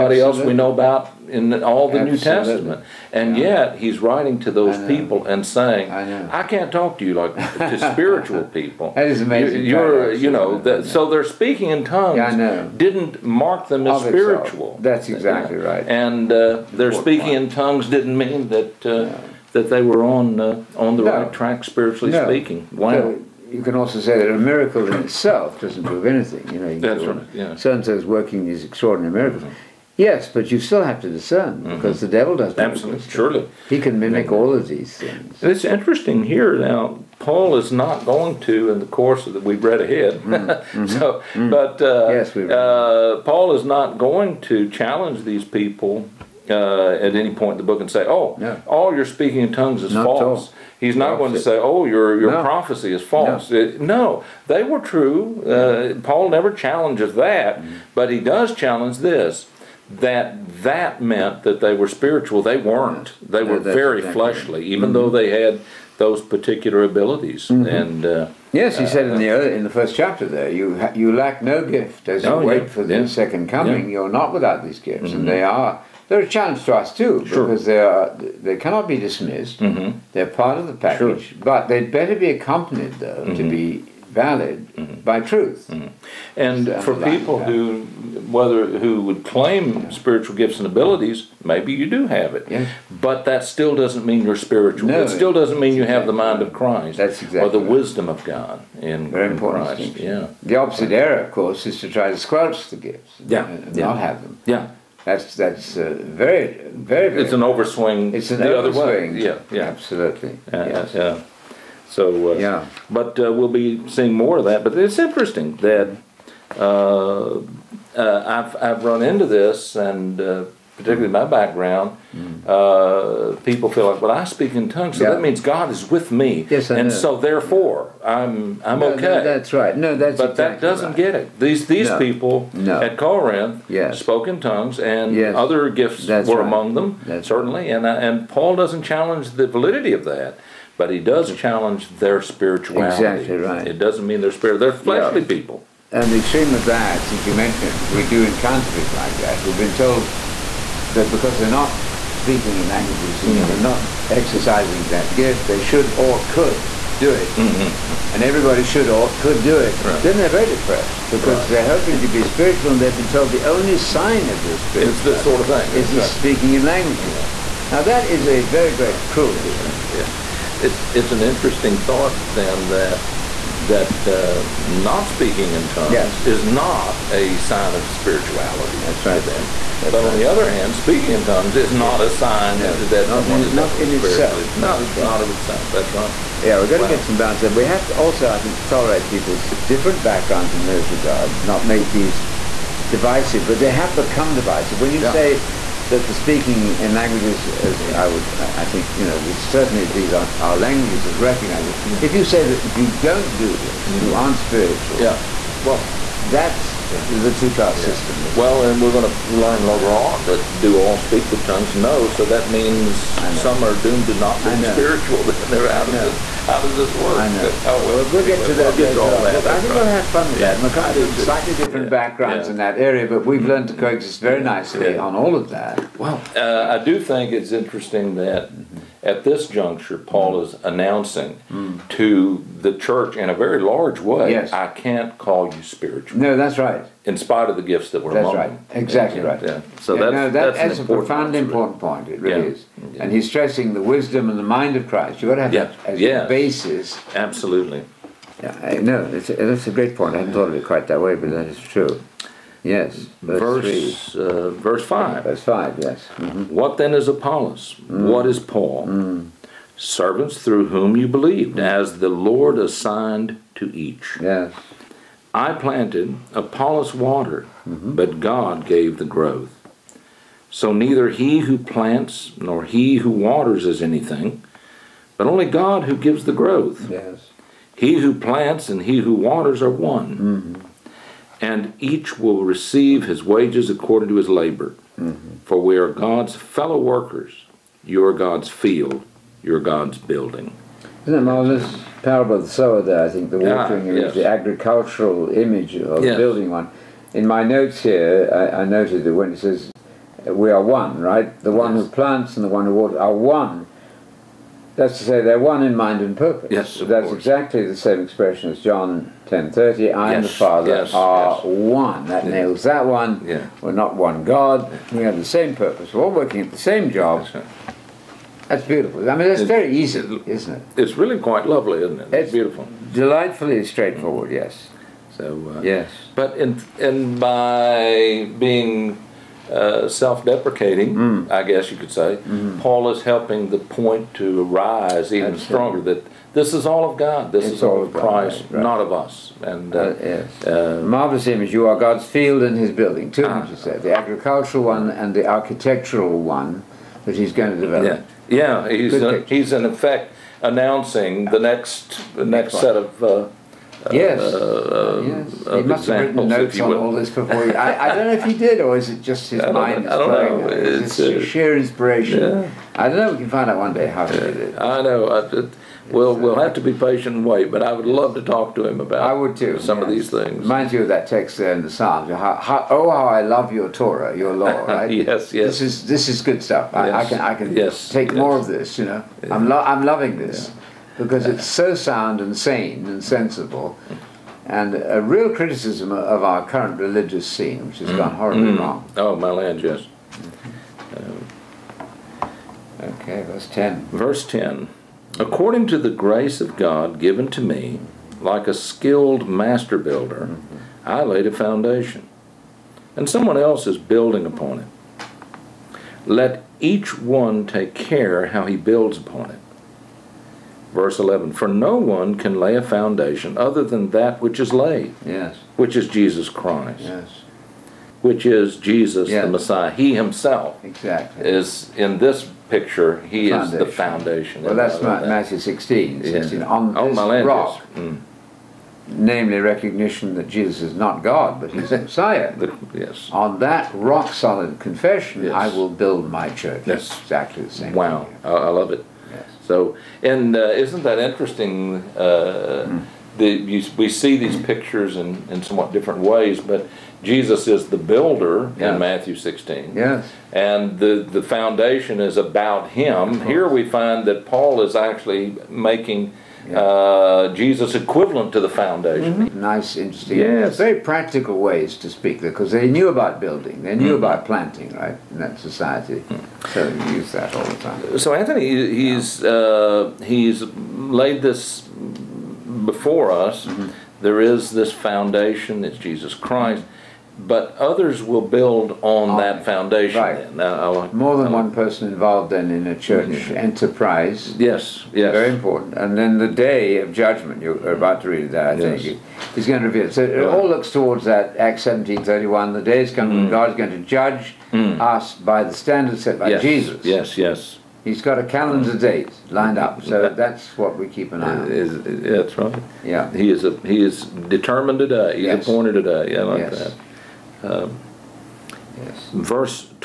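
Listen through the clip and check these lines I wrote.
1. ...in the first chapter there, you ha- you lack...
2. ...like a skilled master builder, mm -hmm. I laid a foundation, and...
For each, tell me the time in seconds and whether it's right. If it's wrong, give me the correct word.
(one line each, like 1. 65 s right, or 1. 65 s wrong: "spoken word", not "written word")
1. 69 s right
2. 398 s right.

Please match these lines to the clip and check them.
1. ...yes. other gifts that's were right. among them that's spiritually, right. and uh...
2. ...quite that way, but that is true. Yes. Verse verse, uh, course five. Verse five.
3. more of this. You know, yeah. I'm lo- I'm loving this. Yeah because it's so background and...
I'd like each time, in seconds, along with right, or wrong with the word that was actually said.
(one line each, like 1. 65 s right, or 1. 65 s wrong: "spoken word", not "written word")
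1. 135 s wrong: "certainly", not "spiritually"
2. 250 s wrong: "verse", not "course"
3. 378 s wrong: "sound", not "background".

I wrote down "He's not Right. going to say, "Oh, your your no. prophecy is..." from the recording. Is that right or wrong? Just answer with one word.
wrong.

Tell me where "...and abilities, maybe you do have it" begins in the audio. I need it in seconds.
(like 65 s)
90 s.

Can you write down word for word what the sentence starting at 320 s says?
It's really quite lovely, isn't it?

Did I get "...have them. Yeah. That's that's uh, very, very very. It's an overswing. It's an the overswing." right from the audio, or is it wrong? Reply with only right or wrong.
right.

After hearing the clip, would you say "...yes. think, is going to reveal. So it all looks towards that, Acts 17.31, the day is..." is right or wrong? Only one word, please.
right.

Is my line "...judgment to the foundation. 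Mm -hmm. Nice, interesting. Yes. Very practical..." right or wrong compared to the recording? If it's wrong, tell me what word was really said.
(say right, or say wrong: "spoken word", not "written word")
wrong: "equivalent", not "judgment".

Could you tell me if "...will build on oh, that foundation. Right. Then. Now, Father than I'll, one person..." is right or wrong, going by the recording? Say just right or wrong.
wrong.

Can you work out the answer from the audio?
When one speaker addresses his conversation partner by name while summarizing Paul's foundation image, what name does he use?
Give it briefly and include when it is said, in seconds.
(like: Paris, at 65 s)
Anthony, at 468 s.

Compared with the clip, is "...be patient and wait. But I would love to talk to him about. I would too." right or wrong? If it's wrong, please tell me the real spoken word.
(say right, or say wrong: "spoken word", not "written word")
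right.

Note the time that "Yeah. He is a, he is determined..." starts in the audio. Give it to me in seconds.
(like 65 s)
502 s.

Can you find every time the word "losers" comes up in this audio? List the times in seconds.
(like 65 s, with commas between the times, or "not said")
not said.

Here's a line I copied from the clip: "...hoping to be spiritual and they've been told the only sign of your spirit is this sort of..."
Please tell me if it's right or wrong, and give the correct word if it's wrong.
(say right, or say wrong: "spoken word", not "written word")
right.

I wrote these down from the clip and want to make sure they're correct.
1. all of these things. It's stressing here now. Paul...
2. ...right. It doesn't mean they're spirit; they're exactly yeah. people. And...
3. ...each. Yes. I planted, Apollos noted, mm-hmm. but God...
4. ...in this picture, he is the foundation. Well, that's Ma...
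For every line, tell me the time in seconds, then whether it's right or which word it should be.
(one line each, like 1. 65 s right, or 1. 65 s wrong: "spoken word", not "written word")
1. 34 s wrong: "interesting", not "stressing"
2. 143 s wrong: "fleshly", not "exactly"
3. 263 s wrong: "watered", not "noted"
4. 421 s right.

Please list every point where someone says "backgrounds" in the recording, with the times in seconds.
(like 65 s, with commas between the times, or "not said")
121 s, 190 s, 221 s.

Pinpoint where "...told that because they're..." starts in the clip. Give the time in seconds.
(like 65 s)
149 s.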